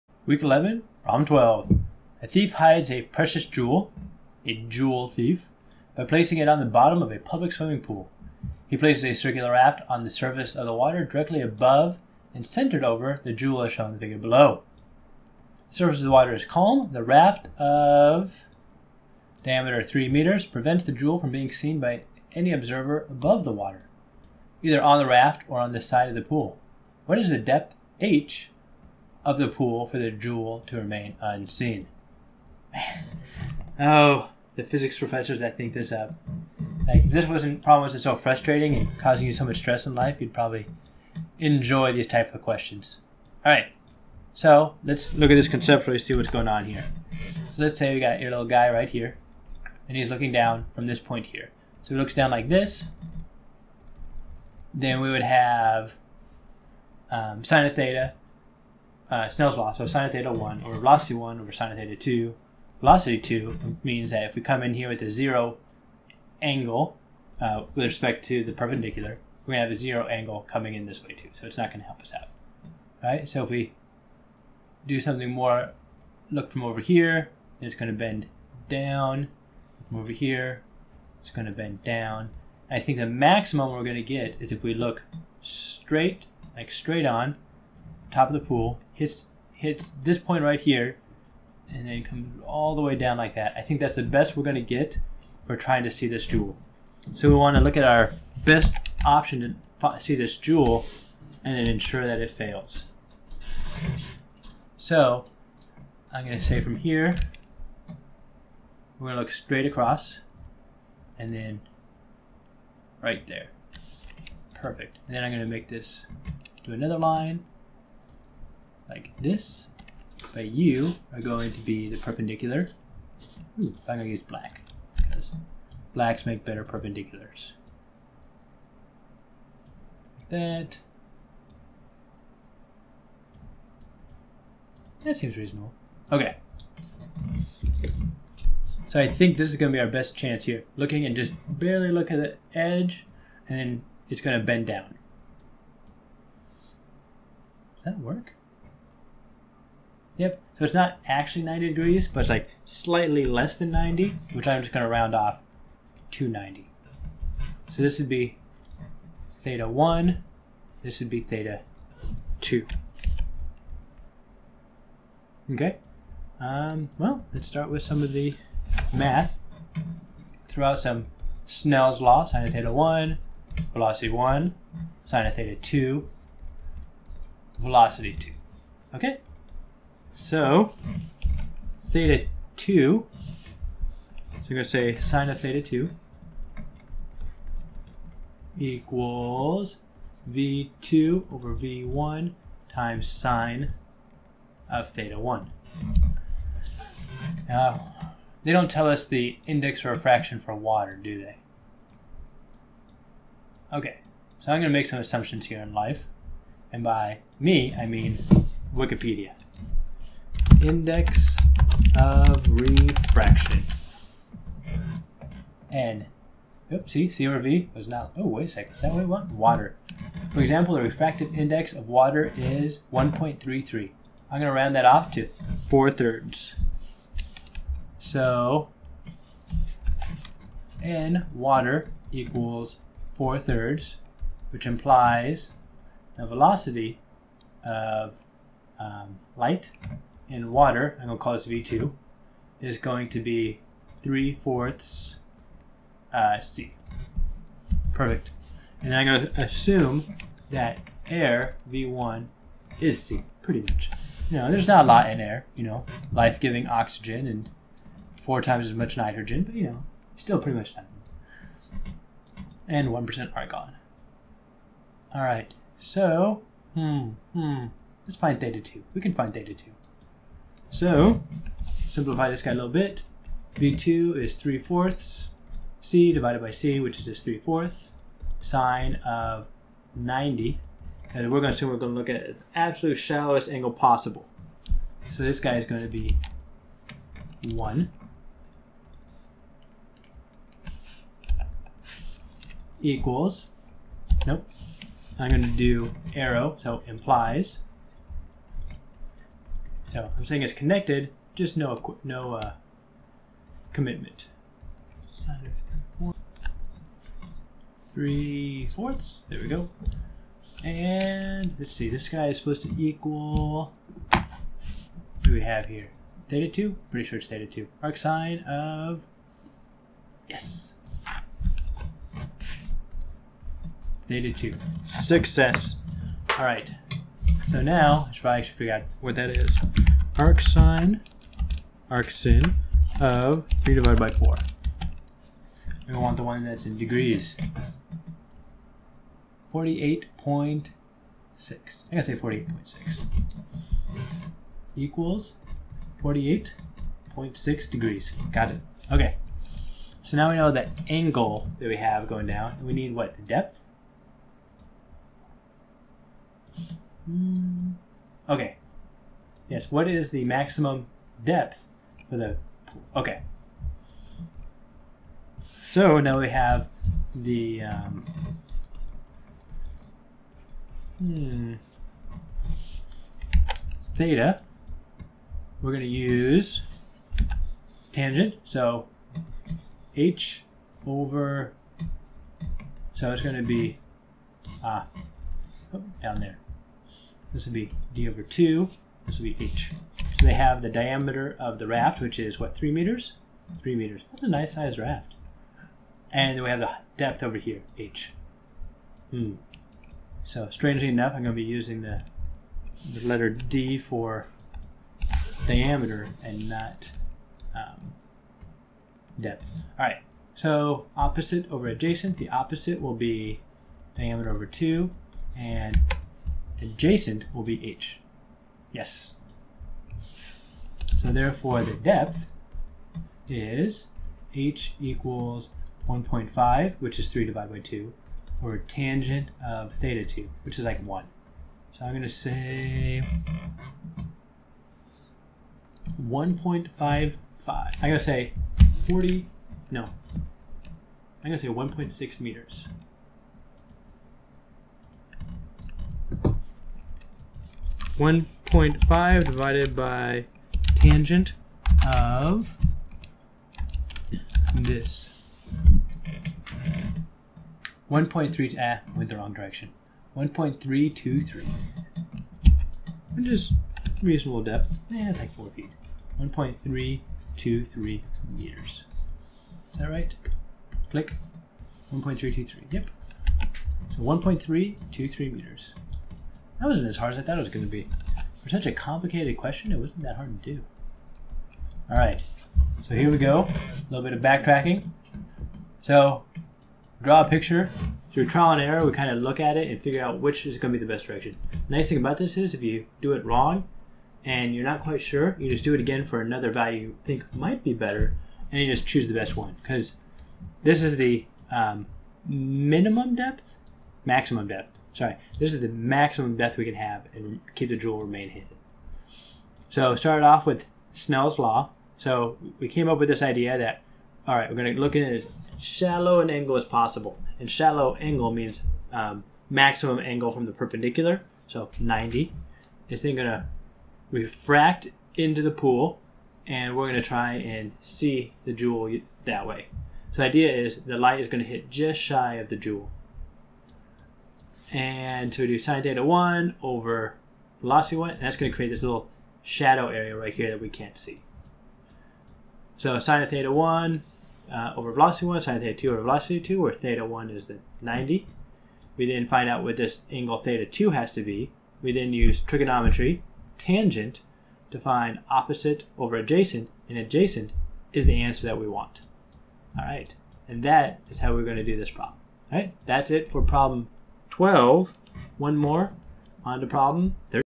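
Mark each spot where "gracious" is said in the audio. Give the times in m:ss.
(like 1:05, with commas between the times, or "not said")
not said.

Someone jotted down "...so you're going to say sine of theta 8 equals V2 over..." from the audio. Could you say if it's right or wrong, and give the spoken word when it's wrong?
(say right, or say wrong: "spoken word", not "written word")
wrong: "2", not "8".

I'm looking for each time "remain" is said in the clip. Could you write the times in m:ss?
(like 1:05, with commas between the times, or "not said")
0:30, 8:28.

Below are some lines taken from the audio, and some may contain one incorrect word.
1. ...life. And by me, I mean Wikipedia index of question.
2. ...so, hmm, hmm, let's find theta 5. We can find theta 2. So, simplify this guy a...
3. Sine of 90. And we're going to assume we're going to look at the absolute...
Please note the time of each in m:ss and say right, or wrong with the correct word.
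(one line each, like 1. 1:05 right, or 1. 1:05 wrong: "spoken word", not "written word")
1. 3:25 wrong: "refraction", not "question"
2. 4:25 wrong: "2", not "5"
3. 4:38 right.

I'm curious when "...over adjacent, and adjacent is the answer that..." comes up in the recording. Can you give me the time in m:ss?
9:15.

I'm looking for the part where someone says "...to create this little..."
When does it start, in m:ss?
8:58.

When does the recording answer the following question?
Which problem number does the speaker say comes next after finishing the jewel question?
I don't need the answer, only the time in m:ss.
9:26.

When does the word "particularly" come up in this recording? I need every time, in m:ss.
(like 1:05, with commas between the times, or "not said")
not said.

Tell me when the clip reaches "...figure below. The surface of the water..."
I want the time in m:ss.
0:13.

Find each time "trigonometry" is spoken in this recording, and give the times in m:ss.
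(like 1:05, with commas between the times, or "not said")
9:12.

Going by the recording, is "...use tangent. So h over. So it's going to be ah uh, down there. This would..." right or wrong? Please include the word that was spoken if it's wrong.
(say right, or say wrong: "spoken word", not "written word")
right.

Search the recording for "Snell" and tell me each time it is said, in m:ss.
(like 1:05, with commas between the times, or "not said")
0:59, 2:51, 8:30.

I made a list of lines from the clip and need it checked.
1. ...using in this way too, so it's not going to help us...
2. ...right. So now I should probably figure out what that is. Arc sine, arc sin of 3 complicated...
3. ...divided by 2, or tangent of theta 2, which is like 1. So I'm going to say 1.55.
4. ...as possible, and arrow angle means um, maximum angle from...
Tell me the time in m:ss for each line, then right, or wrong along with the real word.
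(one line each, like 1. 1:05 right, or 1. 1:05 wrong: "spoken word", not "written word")
1. 1:10 wrong: "coming", not "using"
2. 5:26 wrong: "divided", not "complicated"
3. 7:07 right
4. 8:36 wrong: "shallow", not "arrow".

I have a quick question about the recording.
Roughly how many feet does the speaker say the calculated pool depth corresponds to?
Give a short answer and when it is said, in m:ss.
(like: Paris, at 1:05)
4 feet, at 7:45.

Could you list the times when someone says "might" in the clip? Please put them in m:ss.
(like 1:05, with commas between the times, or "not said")
8:17.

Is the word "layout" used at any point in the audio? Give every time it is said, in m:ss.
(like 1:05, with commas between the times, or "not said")
not said.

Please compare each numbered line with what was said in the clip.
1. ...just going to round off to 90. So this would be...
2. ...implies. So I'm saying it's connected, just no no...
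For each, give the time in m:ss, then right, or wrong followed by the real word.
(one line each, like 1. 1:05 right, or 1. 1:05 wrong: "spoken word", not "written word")
1. 2:34 right
2. 4:56 right.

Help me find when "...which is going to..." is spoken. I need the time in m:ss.
8:10.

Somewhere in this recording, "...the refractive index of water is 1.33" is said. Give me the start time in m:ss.
3:40.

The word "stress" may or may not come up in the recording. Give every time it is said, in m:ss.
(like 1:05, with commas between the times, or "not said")
0:39.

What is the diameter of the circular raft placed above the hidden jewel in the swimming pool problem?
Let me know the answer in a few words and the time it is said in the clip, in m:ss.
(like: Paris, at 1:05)
3 meters, at 0:19.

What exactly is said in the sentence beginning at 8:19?
Because this is the um, minimum depth, maximum depth.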